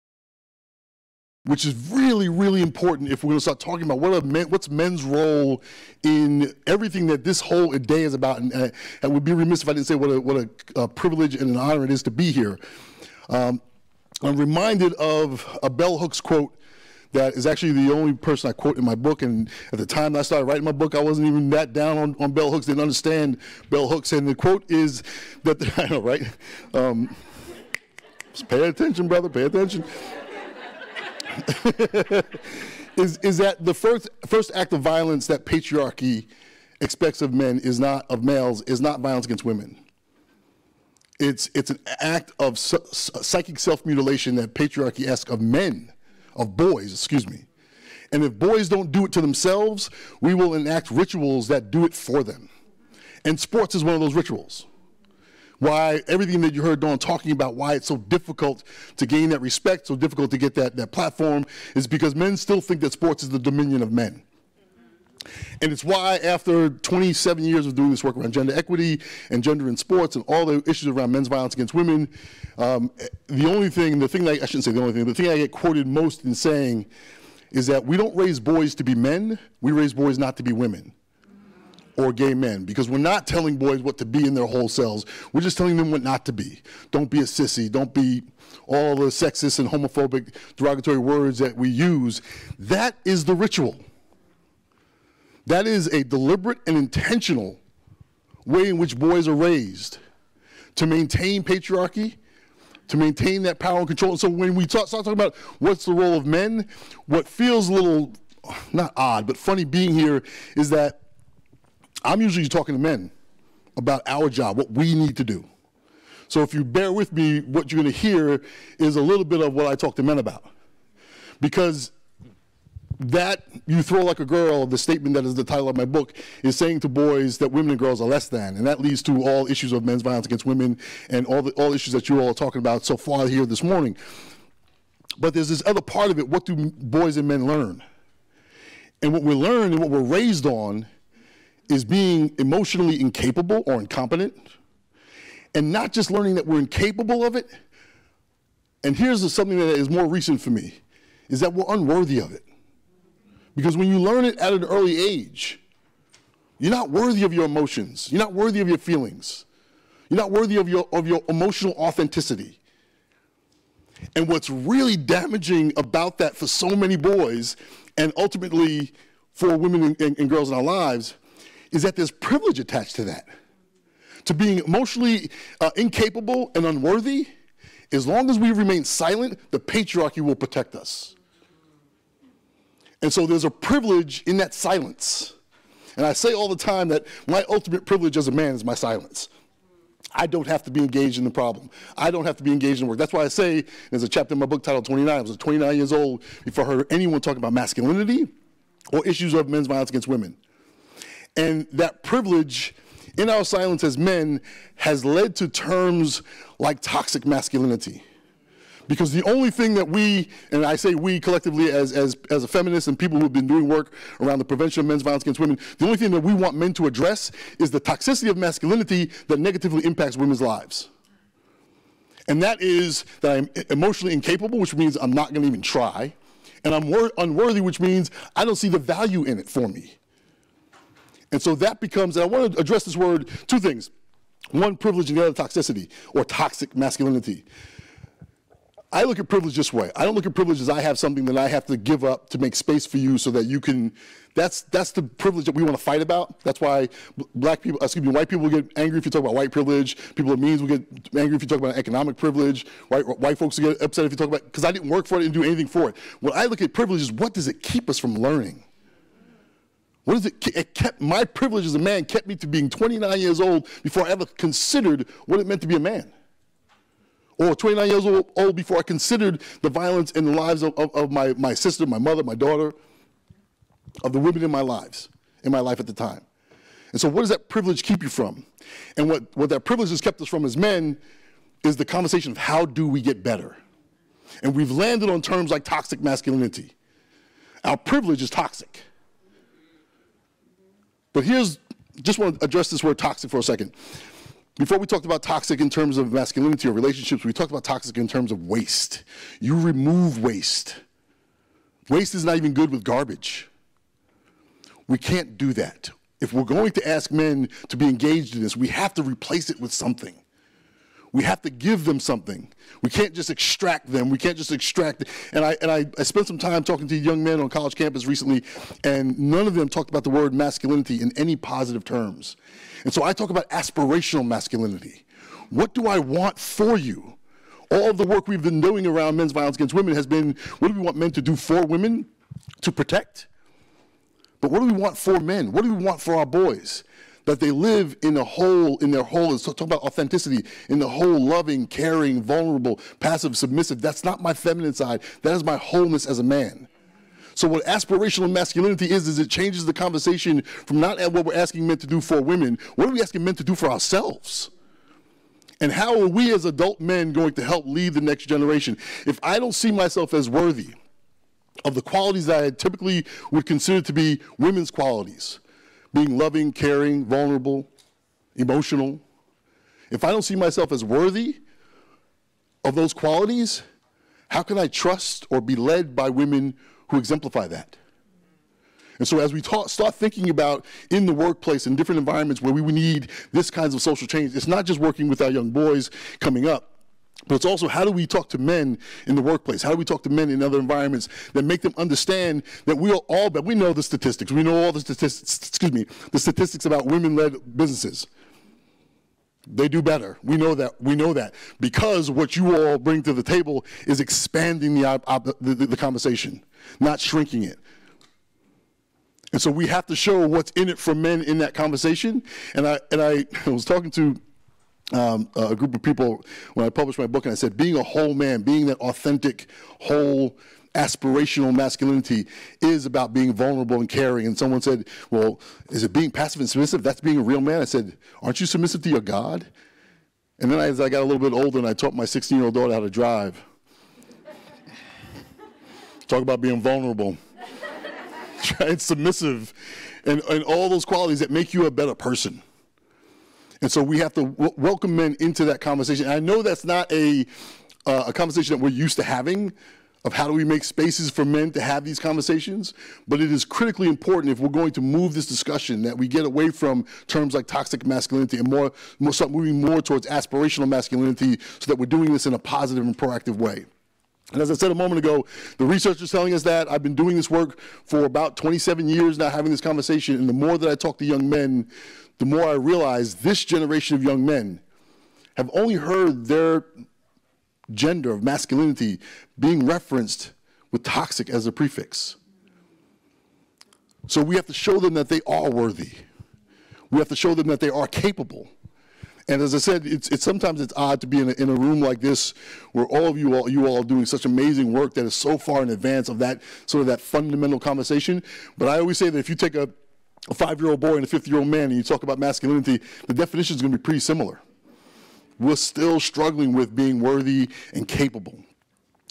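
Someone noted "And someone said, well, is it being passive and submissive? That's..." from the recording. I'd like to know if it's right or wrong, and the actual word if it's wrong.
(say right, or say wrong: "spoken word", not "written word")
right.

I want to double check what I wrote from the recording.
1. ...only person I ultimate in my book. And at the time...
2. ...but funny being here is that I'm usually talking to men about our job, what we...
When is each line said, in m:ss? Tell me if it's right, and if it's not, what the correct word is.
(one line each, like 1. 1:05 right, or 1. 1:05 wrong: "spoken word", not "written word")
1. 0:17 wrong: "quote", not "ultimate"
2. 1:49 right.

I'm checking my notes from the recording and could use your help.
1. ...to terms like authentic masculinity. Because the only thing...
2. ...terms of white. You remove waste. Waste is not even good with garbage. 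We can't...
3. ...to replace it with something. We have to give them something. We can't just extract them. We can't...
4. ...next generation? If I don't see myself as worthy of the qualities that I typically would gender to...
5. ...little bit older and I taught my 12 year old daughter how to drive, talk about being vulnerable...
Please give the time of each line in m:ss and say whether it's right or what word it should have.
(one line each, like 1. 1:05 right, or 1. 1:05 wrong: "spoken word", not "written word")
1. 3:25 wrong: "toxic", not "authentic"
2. 4:58 wrong: "waste", not "white"
3. 5:08 right
4. 5:58 wrong: "consider", not "gender"
5. 7:11 wrong: "16", not "12".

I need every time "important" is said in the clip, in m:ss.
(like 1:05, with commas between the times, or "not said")
0:02, 7:33.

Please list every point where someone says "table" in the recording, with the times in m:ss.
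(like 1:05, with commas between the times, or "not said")
6:43.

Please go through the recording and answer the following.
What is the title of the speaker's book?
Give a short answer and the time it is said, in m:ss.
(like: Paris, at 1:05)
You Throw Like a Girl, at 2:03.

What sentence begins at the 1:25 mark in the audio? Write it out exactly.
We're just telling them what not to be.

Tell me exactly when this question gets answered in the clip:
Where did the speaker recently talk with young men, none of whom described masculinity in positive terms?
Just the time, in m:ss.
5:17.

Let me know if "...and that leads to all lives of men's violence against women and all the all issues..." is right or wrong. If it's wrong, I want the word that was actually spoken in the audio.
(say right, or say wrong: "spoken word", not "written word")
wrong: "issues", not "lives".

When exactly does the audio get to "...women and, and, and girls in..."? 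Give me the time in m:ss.
2:49.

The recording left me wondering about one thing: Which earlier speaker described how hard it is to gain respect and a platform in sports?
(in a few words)
Dawn.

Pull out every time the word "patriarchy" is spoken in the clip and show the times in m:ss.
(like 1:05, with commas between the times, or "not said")
0:35, 0:44, 1:41, 2:59.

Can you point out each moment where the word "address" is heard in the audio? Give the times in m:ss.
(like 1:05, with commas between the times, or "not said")
3:36, 3:52, 4:52.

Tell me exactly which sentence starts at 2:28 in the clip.
And here's something that is more recent for me, is that we're unworthy of it.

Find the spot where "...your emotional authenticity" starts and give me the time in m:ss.
2:41.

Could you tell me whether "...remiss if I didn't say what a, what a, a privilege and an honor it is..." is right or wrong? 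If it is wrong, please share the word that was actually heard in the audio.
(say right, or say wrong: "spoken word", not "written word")
right.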